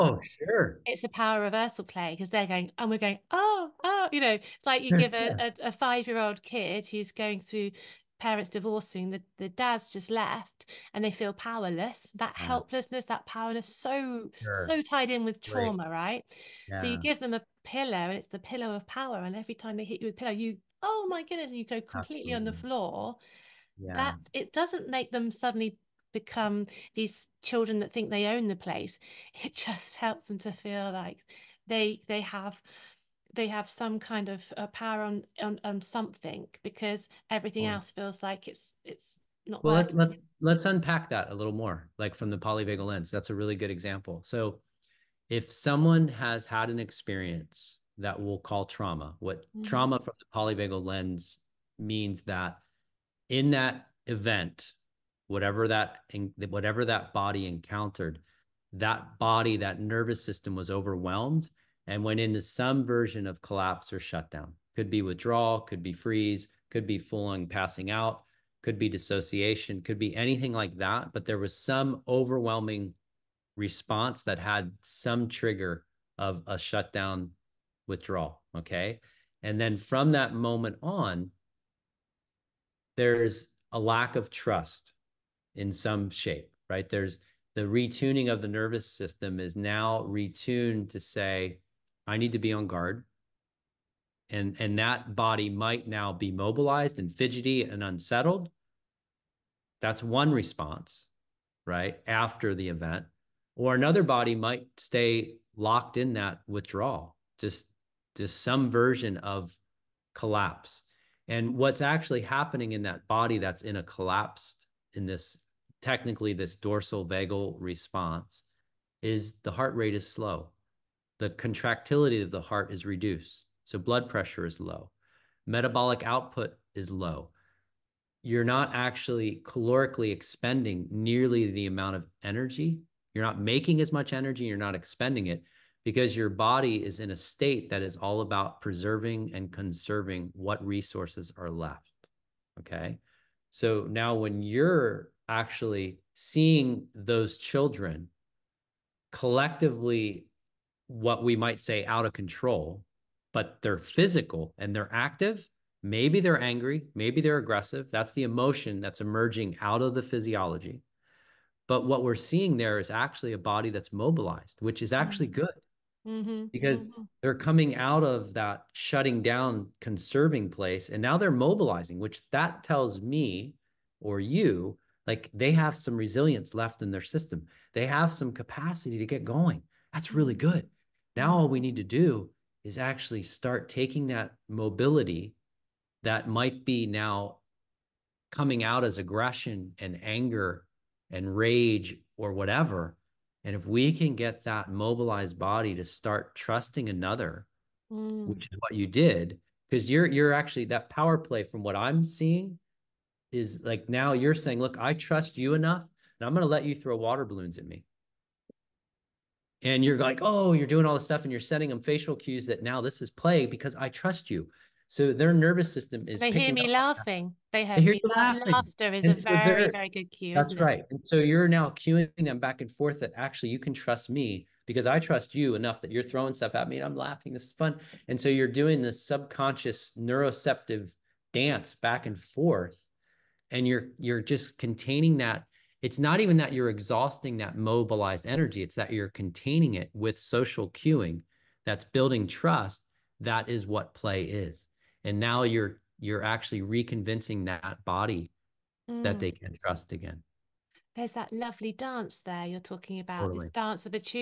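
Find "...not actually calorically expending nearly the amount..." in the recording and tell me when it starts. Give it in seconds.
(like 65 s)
128 s.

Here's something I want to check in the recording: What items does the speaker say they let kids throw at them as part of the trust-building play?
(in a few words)
water balloons.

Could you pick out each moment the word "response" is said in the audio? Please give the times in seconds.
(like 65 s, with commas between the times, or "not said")
73 s, 100 s, 117 s.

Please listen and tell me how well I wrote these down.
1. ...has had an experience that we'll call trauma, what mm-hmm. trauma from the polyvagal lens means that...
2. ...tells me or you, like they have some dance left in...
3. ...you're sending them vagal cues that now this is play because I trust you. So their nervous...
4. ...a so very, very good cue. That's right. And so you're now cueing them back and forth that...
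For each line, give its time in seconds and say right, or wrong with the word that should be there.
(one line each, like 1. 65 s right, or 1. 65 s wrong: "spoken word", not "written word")
1. 46 s right
2. 172 s wrong: "resilience", not "dance"
3. 211 s wrong: "facial", not "vagal"
4. 219 s right.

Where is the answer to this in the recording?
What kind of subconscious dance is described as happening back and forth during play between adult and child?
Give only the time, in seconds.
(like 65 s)
229 s.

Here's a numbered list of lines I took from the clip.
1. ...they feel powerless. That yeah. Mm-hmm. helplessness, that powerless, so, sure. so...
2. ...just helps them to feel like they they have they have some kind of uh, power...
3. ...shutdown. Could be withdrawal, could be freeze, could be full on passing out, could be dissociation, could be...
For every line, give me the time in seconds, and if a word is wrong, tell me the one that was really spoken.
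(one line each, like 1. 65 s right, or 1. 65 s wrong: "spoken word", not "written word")
1. 11 s right
2. 29 s right
3. 63 s right.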